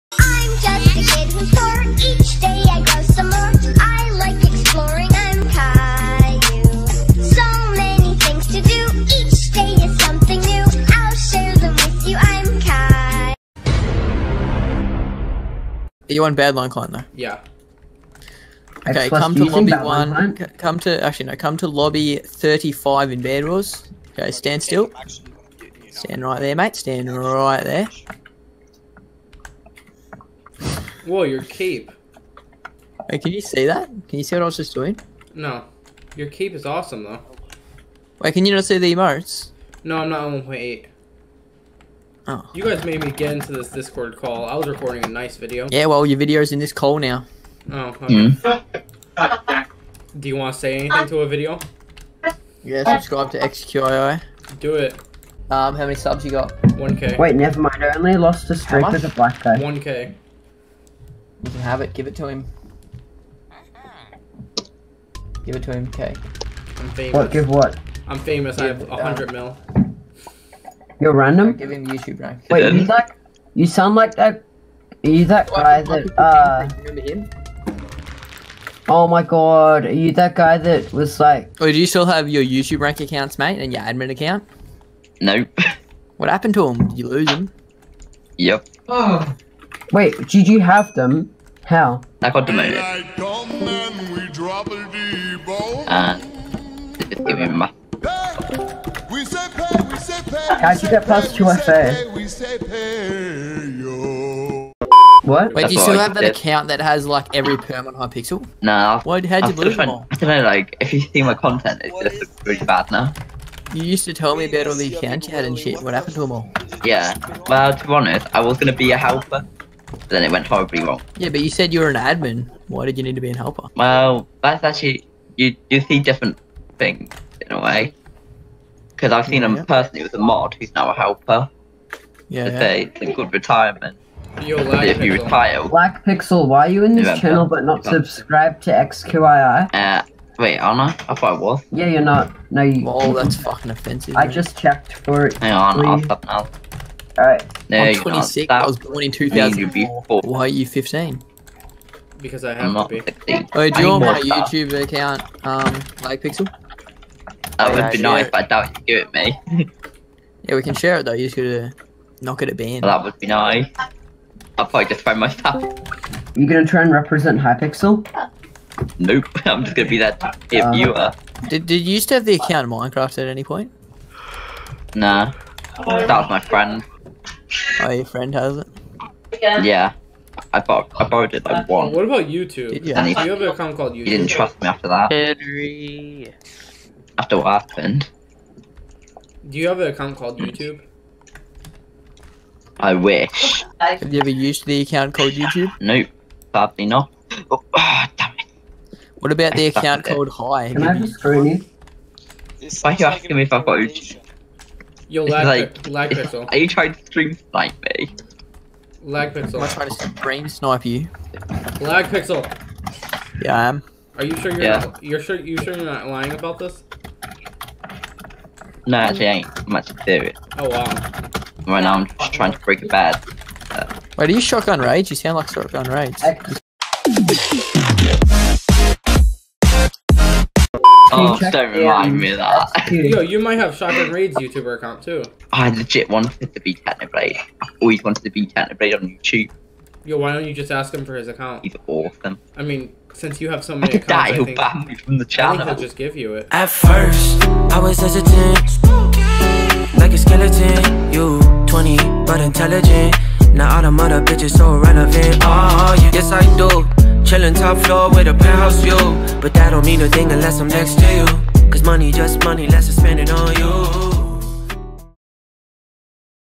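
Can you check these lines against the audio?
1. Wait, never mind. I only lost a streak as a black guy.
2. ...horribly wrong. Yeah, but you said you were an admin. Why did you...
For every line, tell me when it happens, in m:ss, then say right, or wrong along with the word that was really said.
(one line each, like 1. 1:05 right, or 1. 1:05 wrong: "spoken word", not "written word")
1. 0:57 right
2. 2:00 right.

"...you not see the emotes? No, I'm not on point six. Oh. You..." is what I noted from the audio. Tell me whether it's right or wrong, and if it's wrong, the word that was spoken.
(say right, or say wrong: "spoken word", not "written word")
wrong: "eight", not "six".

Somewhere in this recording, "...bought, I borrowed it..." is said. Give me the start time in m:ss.
3:00.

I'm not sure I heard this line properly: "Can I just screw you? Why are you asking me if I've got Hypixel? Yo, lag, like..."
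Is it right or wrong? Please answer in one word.
wrong.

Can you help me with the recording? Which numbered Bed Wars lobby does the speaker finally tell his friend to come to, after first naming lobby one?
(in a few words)
35.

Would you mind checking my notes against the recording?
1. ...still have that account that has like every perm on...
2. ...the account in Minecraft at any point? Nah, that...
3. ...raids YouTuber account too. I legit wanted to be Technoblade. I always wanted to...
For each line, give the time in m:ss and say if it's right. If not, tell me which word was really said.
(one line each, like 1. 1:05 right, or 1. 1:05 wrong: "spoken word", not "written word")
1. 1:45 right
2. 2:52 right
3. 3:54 right.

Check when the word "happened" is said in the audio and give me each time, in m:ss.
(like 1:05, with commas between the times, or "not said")
1:26, 1:55, 3:07.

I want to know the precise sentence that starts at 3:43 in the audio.
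Uh, Wait, are you shotgun rage?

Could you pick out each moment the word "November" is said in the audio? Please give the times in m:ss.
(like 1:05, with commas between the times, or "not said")
2:17.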